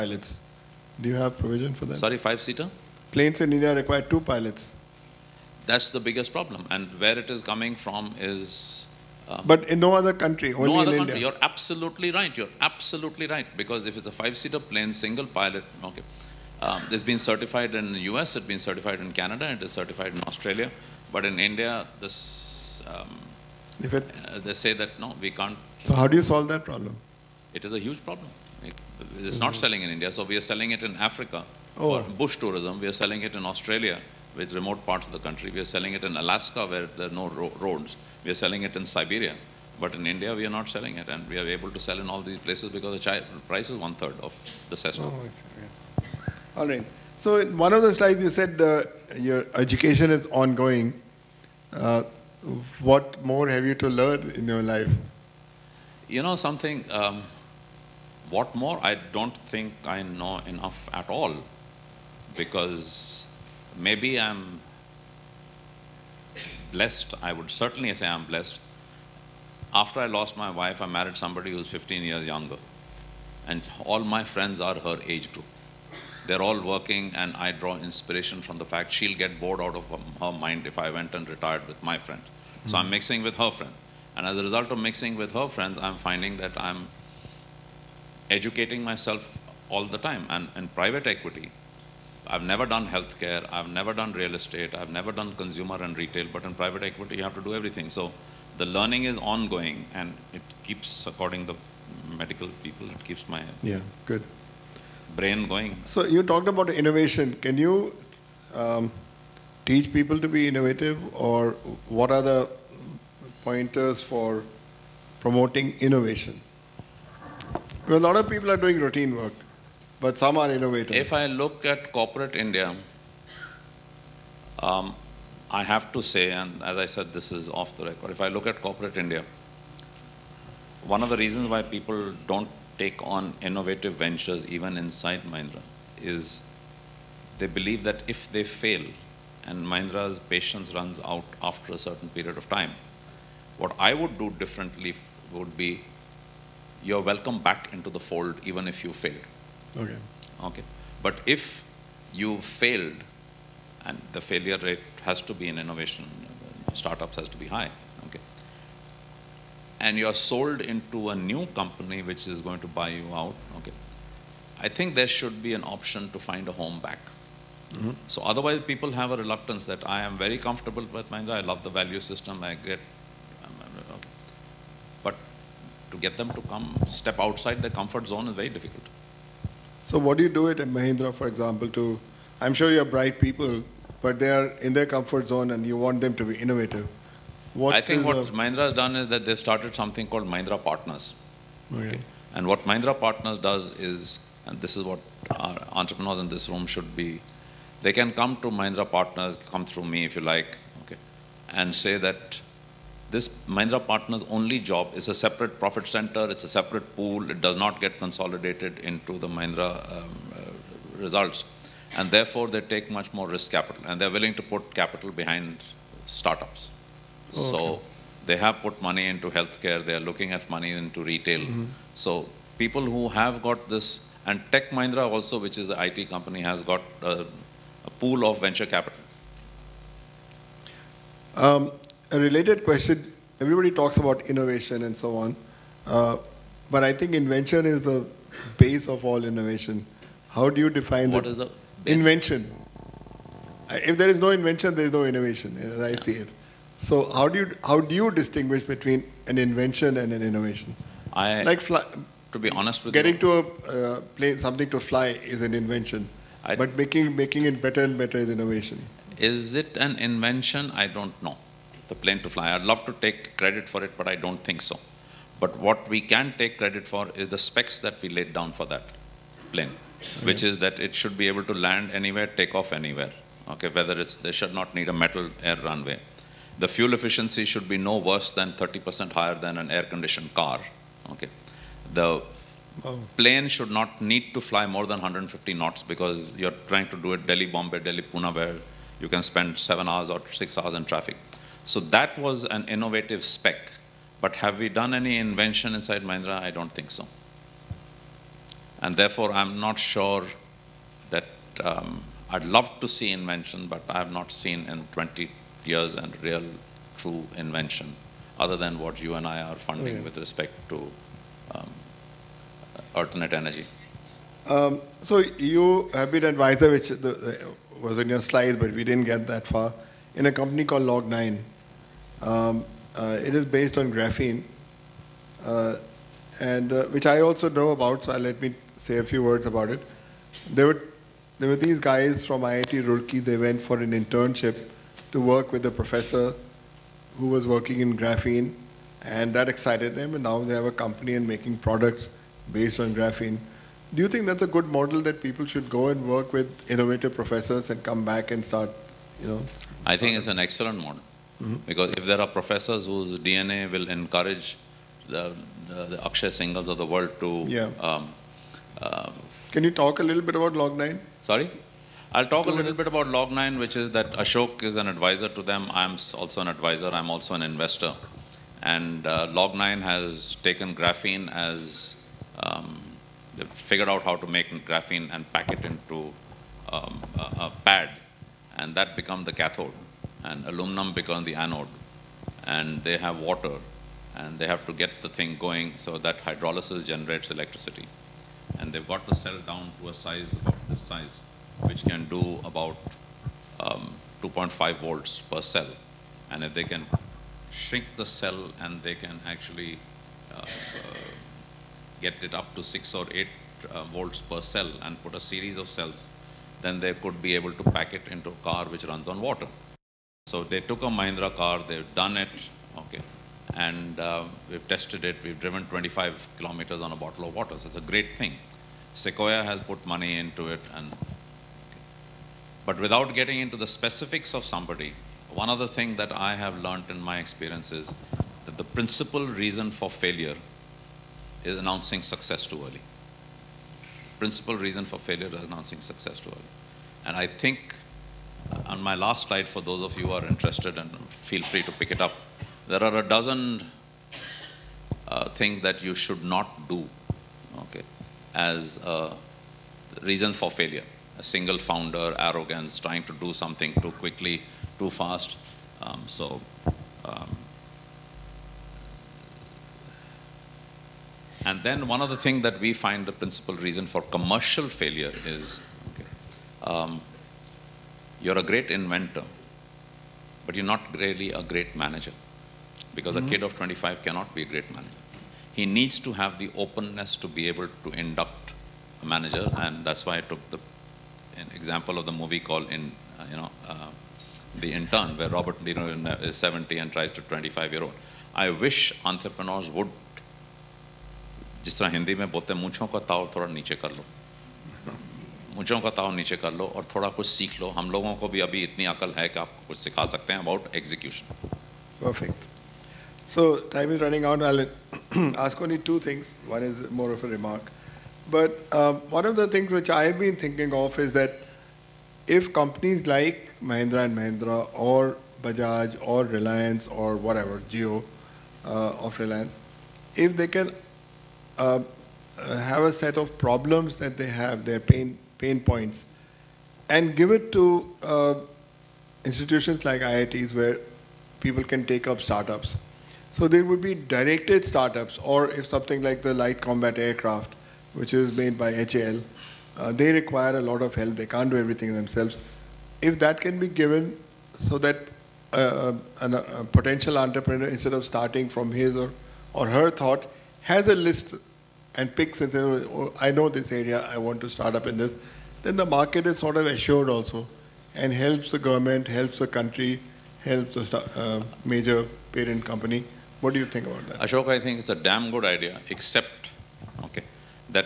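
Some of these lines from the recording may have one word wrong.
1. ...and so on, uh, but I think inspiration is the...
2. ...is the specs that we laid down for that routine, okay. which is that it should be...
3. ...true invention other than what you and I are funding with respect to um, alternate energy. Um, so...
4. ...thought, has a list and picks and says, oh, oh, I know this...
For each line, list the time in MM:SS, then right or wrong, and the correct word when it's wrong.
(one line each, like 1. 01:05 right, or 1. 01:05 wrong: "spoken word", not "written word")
1. 03:54 wrong: "invention", not "inspiration"
2. 04:27 wrong: "plane", not "routine"
3. 05:06 right
4. 09:09 right.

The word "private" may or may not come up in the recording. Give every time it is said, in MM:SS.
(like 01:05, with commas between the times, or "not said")
01:30, 01:36.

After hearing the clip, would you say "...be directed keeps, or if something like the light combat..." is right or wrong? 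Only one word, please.
wrong.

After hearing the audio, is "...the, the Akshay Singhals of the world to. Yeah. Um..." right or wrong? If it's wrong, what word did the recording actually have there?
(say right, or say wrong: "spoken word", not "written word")
right.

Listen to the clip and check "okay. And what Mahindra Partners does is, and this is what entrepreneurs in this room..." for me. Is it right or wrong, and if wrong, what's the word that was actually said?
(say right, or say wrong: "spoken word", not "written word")
right.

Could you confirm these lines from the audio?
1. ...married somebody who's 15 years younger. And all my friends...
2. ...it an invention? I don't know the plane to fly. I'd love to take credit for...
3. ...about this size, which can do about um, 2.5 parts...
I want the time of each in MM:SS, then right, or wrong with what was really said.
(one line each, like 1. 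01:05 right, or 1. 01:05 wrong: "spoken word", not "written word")
1. 01:10 right
2. 04:19 right
3. 06:30 wrong: "volts", not "parts".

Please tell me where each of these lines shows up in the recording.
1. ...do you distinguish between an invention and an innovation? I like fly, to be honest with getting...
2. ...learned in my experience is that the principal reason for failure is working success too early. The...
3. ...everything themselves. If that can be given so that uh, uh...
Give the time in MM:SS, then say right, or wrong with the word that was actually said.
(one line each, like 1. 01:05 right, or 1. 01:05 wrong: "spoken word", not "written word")
1. 04:07 right
2. 07:06 wrong: "announcing", not "working"
3. 09:01 right.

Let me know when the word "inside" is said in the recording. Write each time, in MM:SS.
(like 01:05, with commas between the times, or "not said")
02:14, 04:55.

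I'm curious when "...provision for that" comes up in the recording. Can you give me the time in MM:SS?
00:01.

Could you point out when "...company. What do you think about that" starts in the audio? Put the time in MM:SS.
09:22.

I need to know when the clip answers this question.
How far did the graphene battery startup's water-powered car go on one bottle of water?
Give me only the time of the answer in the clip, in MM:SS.
06:55.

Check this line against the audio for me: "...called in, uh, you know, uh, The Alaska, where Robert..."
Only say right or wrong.
wrong.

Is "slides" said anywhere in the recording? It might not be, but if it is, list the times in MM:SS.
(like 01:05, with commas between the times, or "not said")
00:47, 05:18, 07:19.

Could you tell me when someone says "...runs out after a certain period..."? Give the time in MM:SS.
02:20.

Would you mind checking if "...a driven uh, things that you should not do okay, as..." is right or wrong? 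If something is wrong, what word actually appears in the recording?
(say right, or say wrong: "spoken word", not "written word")
wrong: "dozen", not "driven".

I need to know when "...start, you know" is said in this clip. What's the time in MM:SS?
05:48.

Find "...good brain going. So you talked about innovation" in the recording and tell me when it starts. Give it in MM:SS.
01:44.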